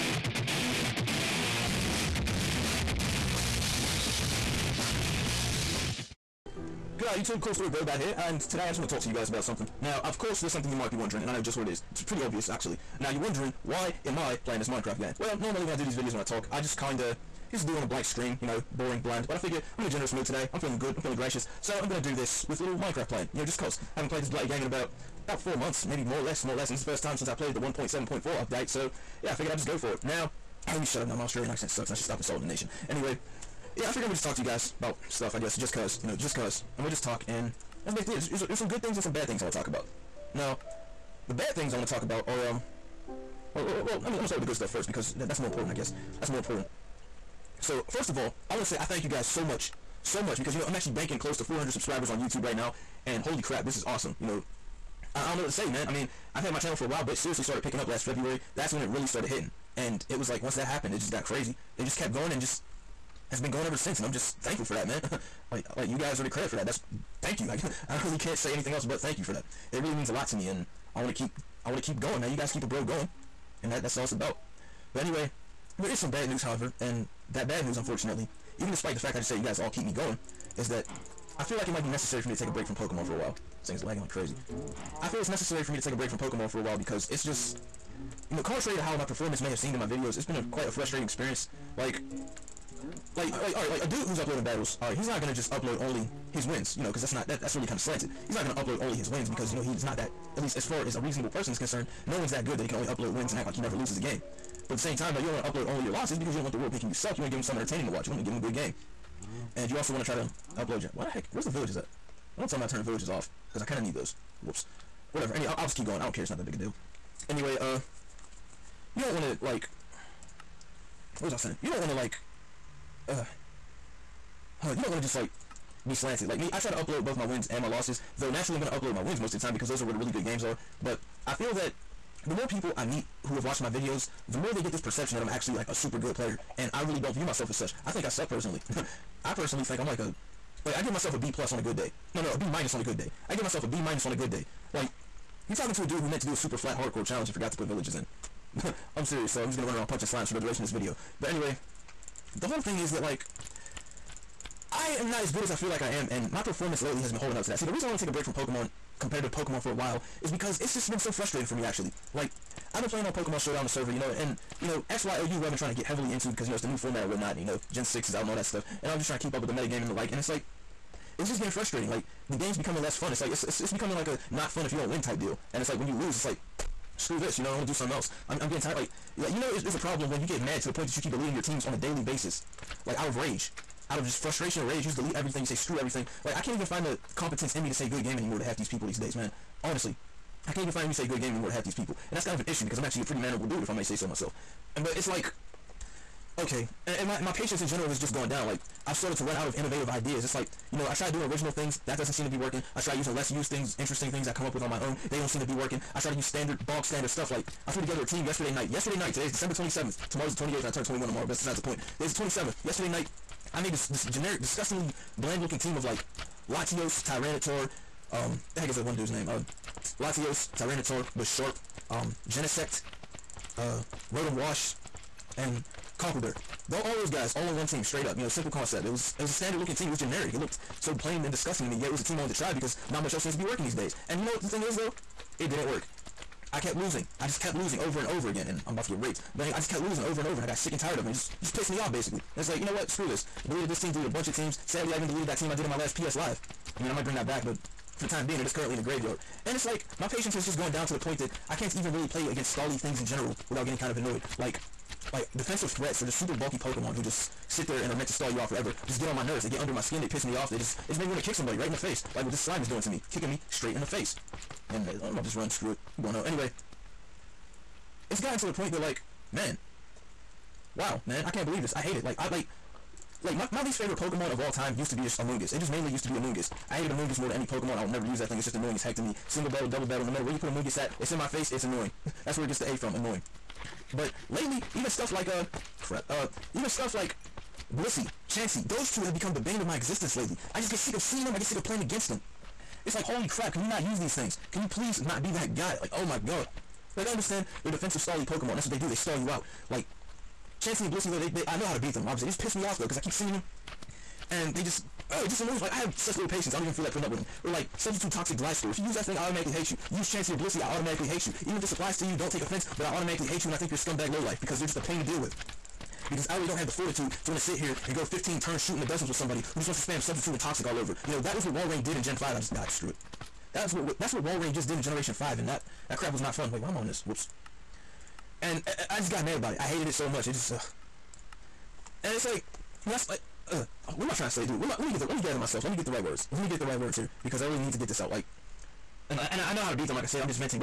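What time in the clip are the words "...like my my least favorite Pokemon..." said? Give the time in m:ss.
4:33.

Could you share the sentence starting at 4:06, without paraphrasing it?
I mean, I might bring that back, but for the time being, it is currently in the graveyard.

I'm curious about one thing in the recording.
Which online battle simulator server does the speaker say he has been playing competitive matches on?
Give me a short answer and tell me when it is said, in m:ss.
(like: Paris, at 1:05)
Pokemon Showdown, at 2:43.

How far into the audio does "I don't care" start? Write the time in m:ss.
1:55.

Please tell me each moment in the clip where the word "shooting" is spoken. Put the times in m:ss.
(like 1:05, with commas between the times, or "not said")
5:18.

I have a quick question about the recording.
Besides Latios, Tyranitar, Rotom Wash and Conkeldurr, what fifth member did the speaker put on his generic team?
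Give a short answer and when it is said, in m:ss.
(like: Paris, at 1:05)
Genesect, at 3:42.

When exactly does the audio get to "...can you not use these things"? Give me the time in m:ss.
4:53.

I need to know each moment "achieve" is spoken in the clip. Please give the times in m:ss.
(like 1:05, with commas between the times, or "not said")
not said.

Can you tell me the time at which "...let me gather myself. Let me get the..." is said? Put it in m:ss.
5:35.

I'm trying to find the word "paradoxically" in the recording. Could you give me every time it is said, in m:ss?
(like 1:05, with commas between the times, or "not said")
not said.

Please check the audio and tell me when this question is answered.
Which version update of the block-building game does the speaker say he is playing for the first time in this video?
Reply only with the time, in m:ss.
0:27.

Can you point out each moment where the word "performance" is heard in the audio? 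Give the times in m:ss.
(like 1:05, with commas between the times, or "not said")
1:29, 2:36.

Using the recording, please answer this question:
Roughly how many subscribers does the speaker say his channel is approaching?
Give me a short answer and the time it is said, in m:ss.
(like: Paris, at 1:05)
400, at 0:51.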